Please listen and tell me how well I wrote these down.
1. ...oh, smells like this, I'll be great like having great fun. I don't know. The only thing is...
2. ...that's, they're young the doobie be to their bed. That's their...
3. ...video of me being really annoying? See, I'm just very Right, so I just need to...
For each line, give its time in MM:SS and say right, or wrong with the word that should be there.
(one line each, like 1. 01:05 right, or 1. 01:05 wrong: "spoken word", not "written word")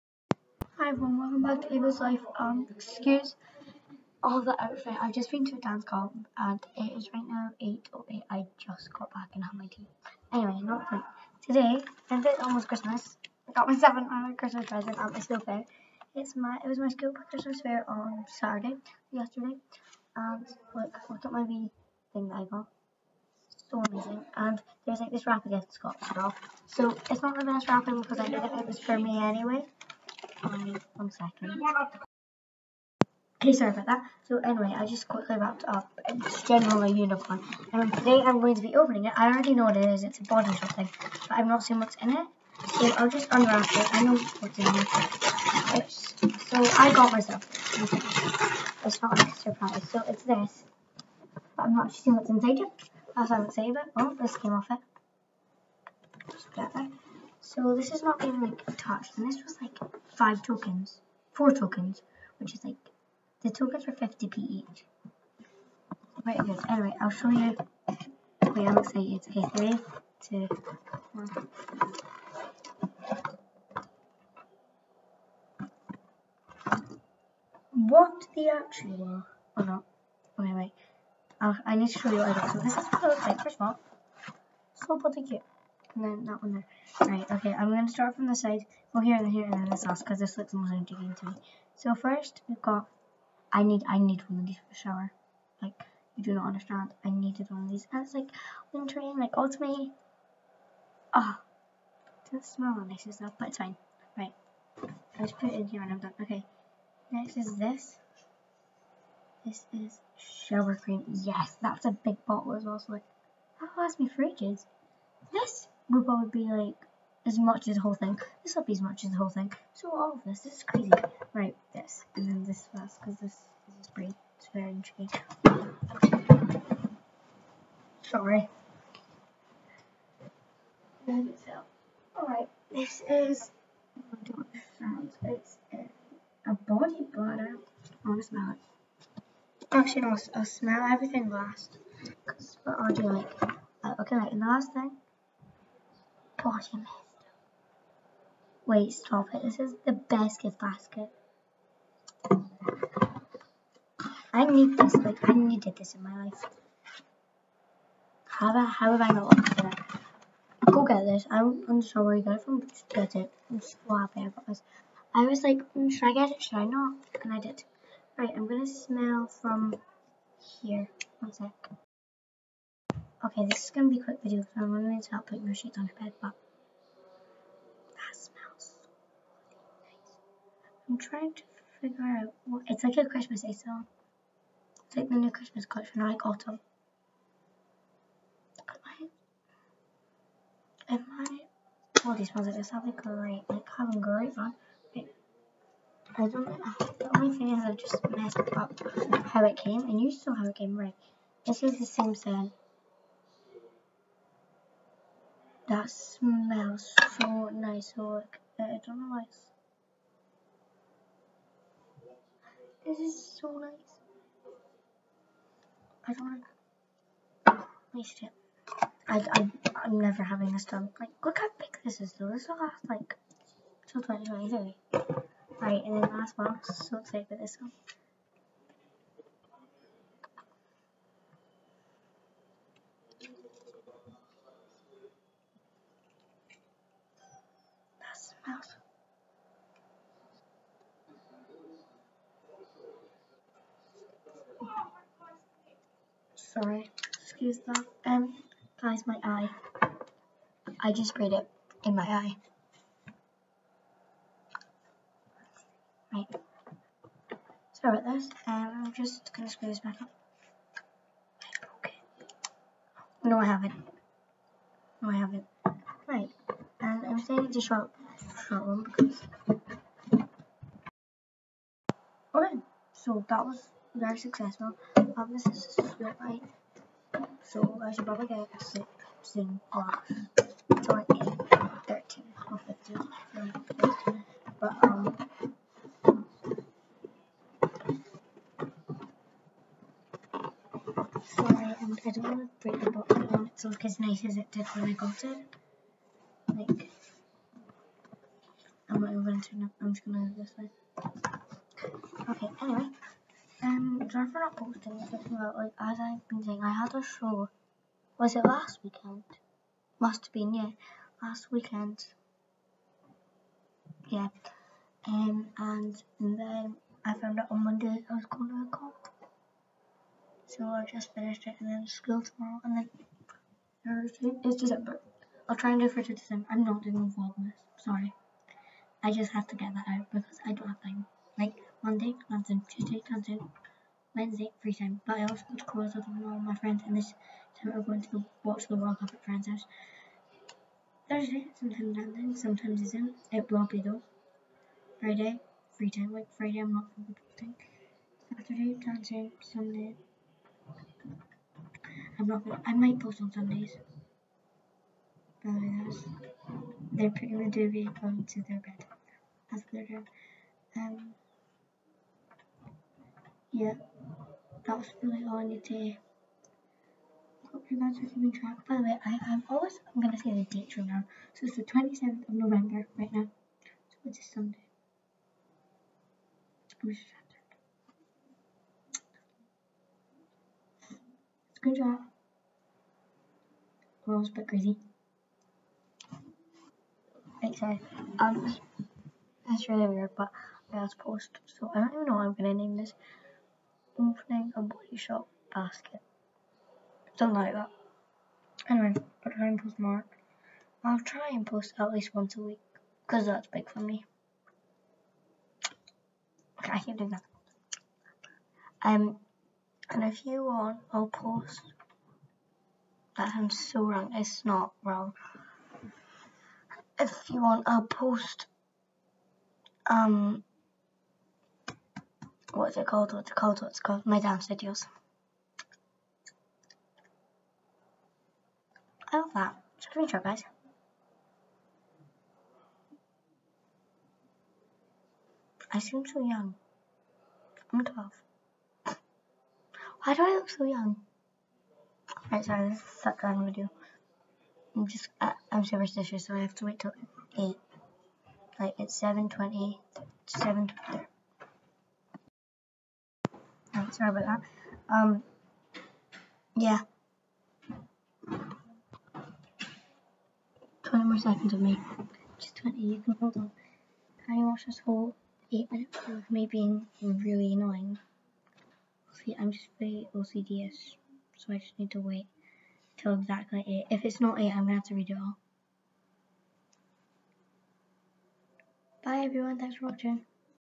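1. 03:12 right
2. 05:55 wrong: "putting", not "young"
3. 07:46 wrong: "OCDs", not "Right".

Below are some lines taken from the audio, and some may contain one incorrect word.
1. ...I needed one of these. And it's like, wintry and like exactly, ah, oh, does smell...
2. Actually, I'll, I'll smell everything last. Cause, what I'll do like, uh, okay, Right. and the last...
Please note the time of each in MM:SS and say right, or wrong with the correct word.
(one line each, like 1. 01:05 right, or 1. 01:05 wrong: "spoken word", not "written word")
1. 01:37 wrong: "ultimately", not "exactly"
2. 02:19 right.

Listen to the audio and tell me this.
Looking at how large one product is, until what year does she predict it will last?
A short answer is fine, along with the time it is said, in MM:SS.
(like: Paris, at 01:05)
2023, at 03:44.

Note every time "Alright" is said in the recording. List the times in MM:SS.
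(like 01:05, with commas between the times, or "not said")
02:11, 04:32.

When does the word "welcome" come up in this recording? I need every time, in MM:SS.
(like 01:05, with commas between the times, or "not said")
00:01.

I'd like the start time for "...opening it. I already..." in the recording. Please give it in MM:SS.
00:38.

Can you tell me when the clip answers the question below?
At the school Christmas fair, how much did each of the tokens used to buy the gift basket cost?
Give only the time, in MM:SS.
01:03.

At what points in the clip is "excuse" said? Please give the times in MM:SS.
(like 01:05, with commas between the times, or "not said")
00:02, 04:07.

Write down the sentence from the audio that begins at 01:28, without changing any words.
Well, here and here and then this last, because this looks most intriguing to me.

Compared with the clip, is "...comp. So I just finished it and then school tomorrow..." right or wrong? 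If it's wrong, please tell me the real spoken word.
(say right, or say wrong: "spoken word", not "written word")
right.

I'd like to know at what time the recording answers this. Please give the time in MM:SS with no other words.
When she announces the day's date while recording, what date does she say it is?
06:11.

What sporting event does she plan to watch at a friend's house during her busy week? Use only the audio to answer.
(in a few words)
World Cup.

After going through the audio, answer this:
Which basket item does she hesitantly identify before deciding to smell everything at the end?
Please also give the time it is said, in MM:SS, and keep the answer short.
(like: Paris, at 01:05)
Body butter, at 02:16.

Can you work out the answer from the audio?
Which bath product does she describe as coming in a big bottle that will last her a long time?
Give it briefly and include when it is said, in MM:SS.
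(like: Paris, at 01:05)
Shower cream, at 01:50.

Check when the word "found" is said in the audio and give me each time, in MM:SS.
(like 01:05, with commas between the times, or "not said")
05:17.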